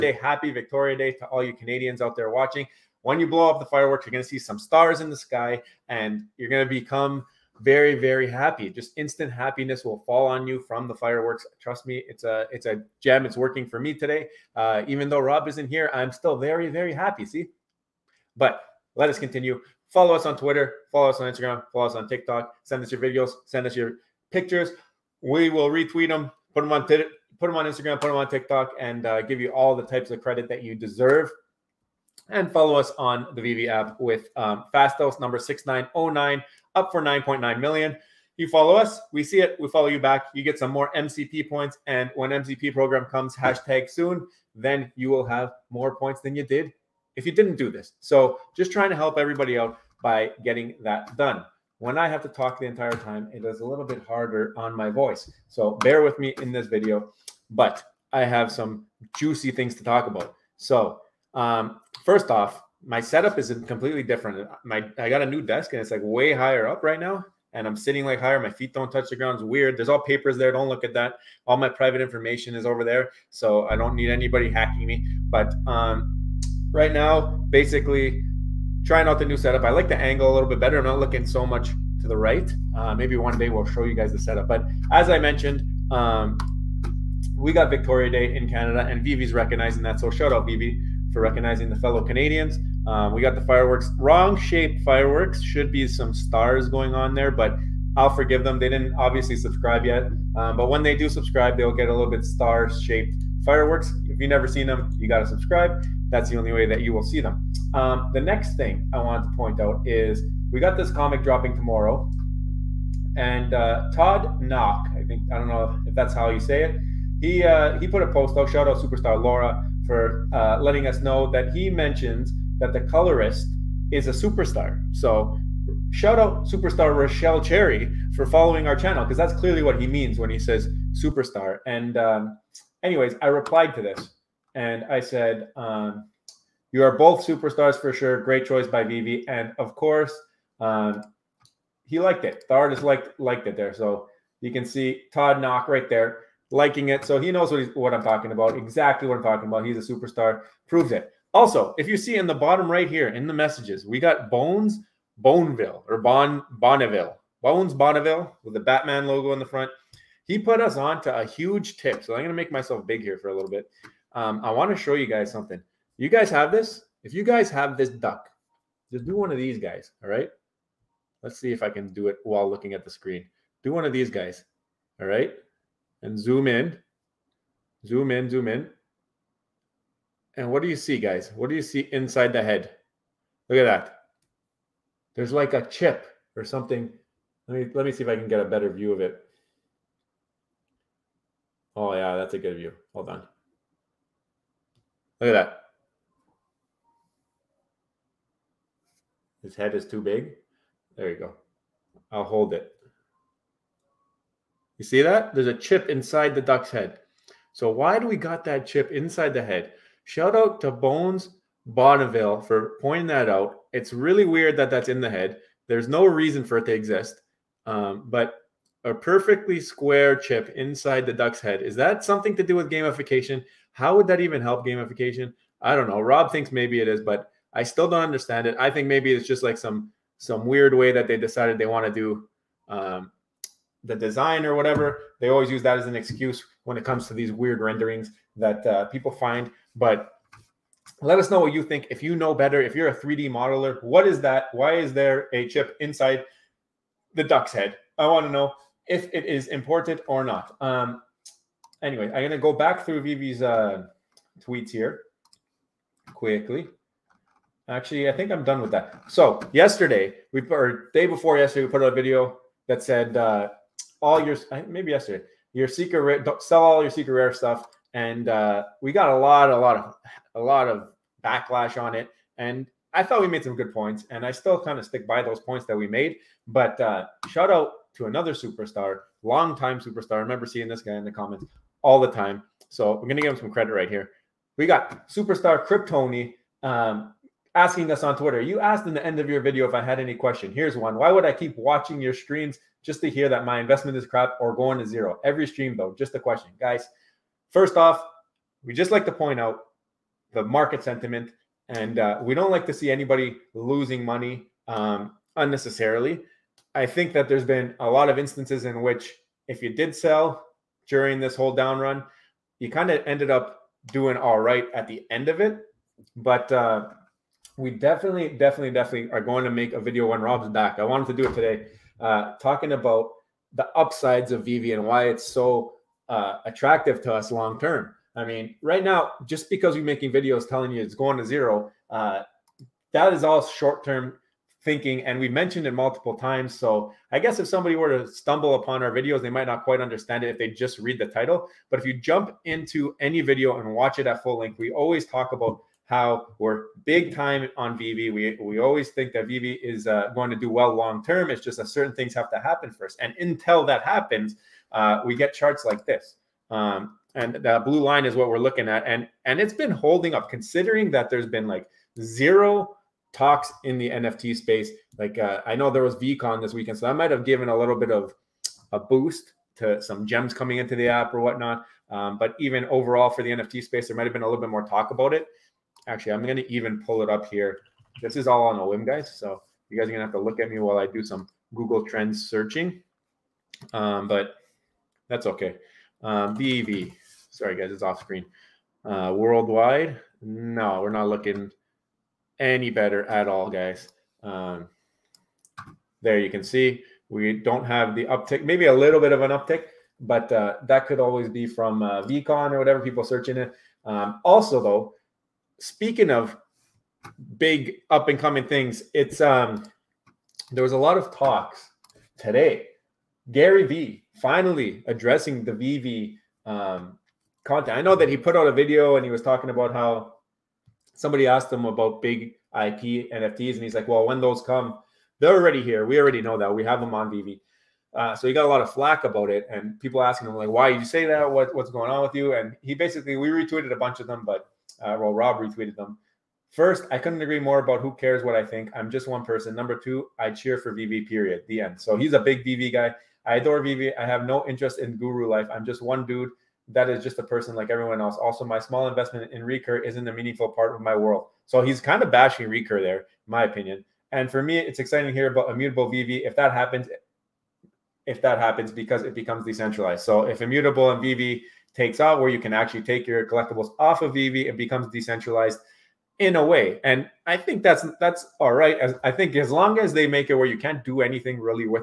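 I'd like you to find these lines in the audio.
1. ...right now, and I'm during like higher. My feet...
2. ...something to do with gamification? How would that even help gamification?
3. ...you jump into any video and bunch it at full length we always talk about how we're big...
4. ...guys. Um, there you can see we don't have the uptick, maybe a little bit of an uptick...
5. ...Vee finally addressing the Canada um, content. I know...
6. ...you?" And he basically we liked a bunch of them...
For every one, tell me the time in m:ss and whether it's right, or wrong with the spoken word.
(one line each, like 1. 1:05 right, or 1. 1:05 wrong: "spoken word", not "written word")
1. 1:06 wrong: "sitting", not "during"
2. 3:42 right
3. 5:41 wrong: "watch", not "bunch"
4. 6:33 right
5. 6:53 wrong: "VeVe", not "Canada"
6. 7:12 wrong: "retweeted", not "liked".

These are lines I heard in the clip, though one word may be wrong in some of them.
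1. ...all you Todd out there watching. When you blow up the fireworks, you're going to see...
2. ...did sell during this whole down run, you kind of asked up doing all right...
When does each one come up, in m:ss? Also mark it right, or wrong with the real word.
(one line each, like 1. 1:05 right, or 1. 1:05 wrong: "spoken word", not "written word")
1. 0:01 wrong: "Canadians", not "Todd"
2. 5:09 wrong: "ended", not "asked".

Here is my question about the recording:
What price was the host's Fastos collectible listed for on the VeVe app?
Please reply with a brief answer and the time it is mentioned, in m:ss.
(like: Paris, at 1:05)
9.9 million, at 0:37.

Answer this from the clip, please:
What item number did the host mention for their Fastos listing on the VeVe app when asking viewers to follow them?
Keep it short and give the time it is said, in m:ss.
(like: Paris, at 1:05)
6909, at 0:35.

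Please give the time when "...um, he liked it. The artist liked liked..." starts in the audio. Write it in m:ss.
2:20.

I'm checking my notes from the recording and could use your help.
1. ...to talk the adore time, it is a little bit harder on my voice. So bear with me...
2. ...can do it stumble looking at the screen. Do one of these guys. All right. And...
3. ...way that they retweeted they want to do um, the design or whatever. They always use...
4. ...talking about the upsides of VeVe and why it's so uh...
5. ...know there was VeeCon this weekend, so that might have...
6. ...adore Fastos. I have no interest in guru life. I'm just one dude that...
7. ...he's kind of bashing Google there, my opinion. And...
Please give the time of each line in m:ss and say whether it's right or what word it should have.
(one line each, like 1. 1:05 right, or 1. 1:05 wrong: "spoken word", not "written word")
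1. 0:52 wrong: "entire", not "adore"
2. 2:51 wrong: "while", not "stumble"
3. 3:50 wrong: "decided", not "retweeted"
4. 5:22 right
5. 6:05 right
6. 7:23 wrong: "VeVe", not "Fastos"
7. 7:31 wrong: "Recur", not "Google".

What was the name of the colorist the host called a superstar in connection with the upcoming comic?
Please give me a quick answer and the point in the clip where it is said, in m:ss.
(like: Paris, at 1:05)
Rochelle Cherry, at 2:06.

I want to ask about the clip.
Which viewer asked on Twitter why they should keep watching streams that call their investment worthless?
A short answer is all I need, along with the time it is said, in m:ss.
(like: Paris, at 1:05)
Kryptoni, at 4:45.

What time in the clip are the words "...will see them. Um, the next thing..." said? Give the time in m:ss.
1:46.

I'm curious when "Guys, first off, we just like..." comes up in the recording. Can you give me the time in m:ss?
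4:56.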